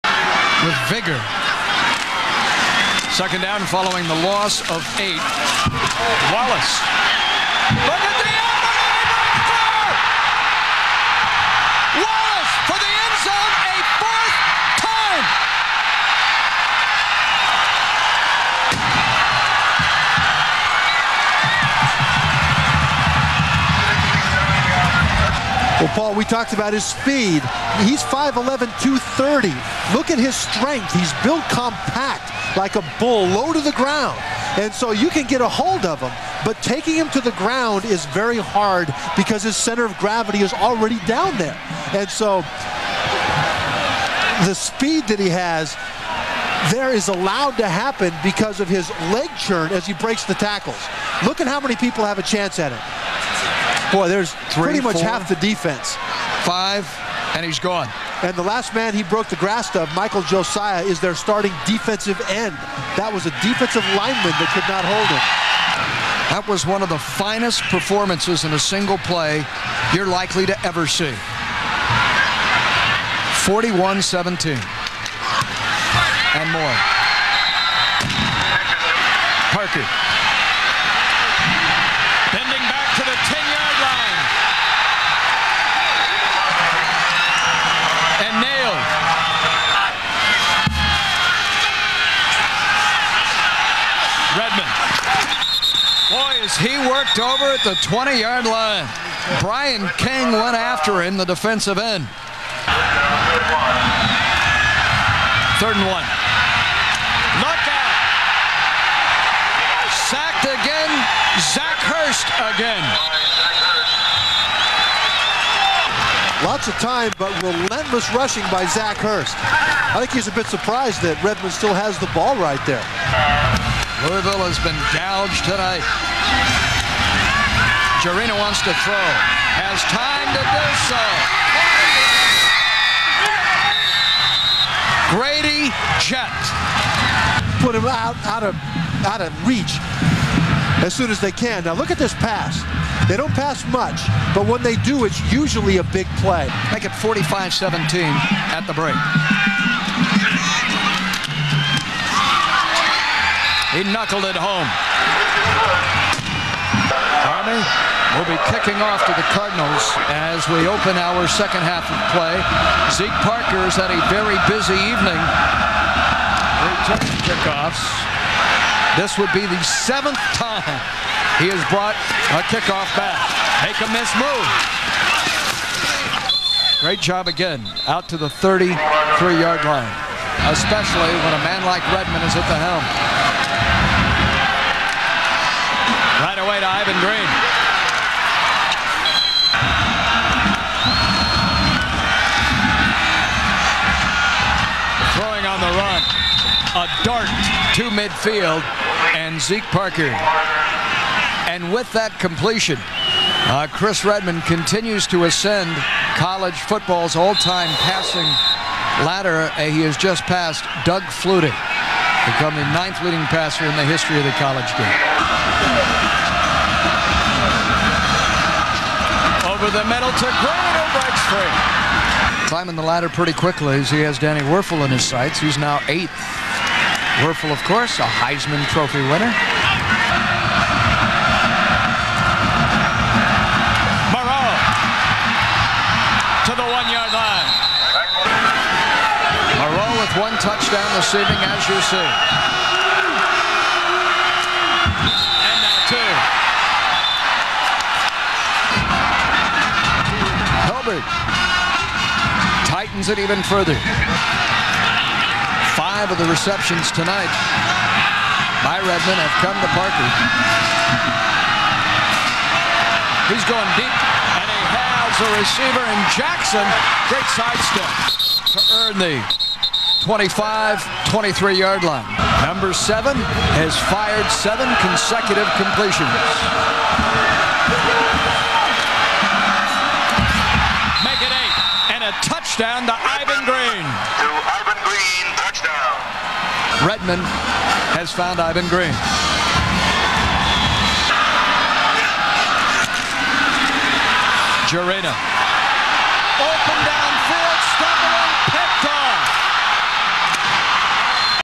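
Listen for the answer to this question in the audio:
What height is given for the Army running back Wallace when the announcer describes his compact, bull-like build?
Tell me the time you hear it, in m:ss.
0:28.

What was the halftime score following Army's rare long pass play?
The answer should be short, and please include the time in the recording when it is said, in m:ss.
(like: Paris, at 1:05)
45-17, at 2:26.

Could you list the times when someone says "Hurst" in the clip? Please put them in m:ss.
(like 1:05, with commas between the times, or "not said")
1:51, 1:58.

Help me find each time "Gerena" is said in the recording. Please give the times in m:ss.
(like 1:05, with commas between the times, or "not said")
2:08, 4:54.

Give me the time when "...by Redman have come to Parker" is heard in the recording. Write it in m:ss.
4:18.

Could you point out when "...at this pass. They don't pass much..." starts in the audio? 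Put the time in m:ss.
2:21.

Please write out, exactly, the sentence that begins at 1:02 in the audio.
That was a defensive lineman that could not hold him.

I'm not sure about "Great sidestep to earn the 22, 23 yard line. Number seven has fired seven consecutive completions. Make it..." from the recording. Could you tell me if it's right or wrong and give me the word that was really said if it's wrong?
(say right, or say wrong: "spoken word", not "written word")
wrong: "25", not "22".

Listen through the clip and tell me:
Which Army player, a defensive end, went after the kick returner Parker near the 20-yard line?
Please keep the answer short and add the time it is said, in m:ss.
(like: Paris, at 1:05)
Brian King, at 1:39.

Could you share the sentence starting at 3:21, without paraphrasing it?
And with that completion, uh, Chris Redman continues to ascend college football's all-time passing ladder.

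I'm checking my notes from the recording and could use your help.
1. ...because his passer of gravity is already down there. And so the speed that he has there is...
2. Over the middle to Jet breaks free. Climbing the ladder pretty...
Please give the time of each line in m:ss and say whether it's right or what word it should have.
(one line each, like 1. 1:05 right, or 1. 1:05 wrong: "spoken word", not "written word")
1. 0:39 wrong: "center", not "passer"
2. 3:39 wrong: "Grano", not "Jet".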